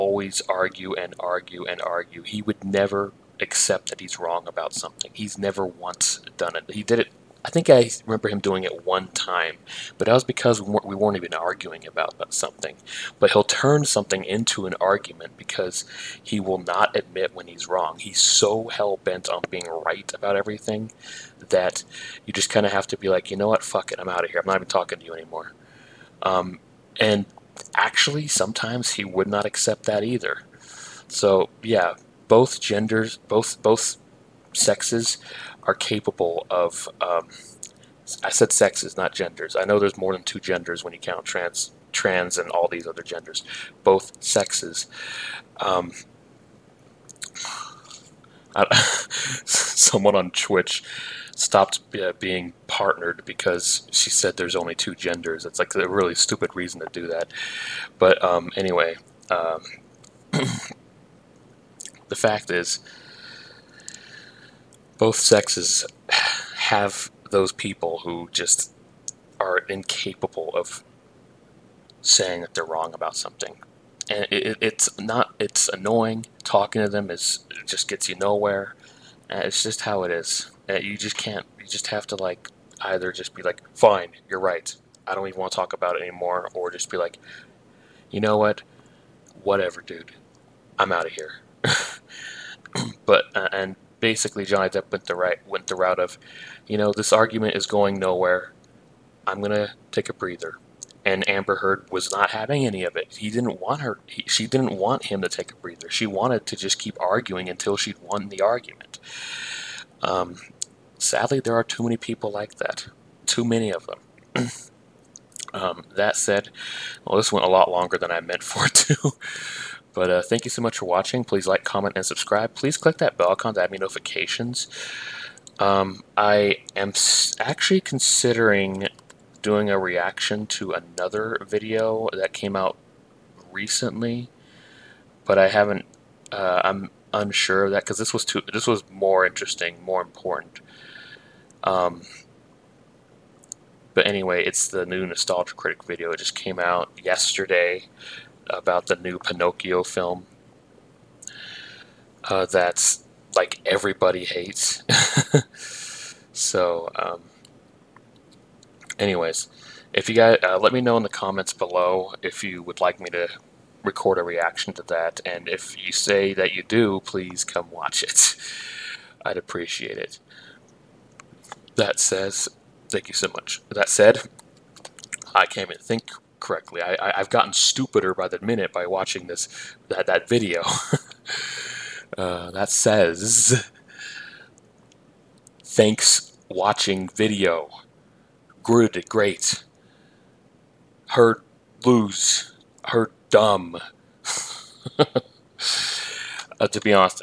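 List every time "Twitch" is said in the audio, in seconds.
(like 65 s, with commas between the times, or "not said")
50 s.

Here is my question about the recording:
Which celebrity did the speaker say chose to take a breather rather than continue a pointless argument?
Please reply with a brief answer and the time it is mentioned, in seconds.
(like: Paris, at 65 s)
Johnny Depp, at 94 s.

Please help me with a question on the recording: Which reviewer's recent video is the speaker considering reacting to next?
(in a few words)
Nostalgia Critic.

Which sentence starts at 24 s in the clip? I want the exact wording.
I'm not even talking to you anymore.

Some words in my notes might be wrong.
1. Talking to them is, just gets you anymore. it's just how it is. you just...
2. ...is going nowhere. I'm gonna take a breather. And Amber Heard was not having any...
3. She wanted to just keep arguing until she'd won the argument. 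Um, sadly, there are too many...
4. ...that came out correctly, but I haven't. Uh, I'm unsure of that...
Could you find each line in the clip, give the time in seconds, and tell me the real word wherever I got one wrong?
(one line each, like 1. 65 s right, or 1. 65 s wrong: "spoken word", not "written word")
1. 76 s wrong: "nowhere", not "anymore"
2. 97 s right
3. 105 s right
4. 132 s wrong: "recently", not "correctly".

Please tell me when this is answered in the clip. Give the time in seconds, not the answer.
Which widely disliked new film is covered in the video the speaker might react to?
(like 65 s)
149 s.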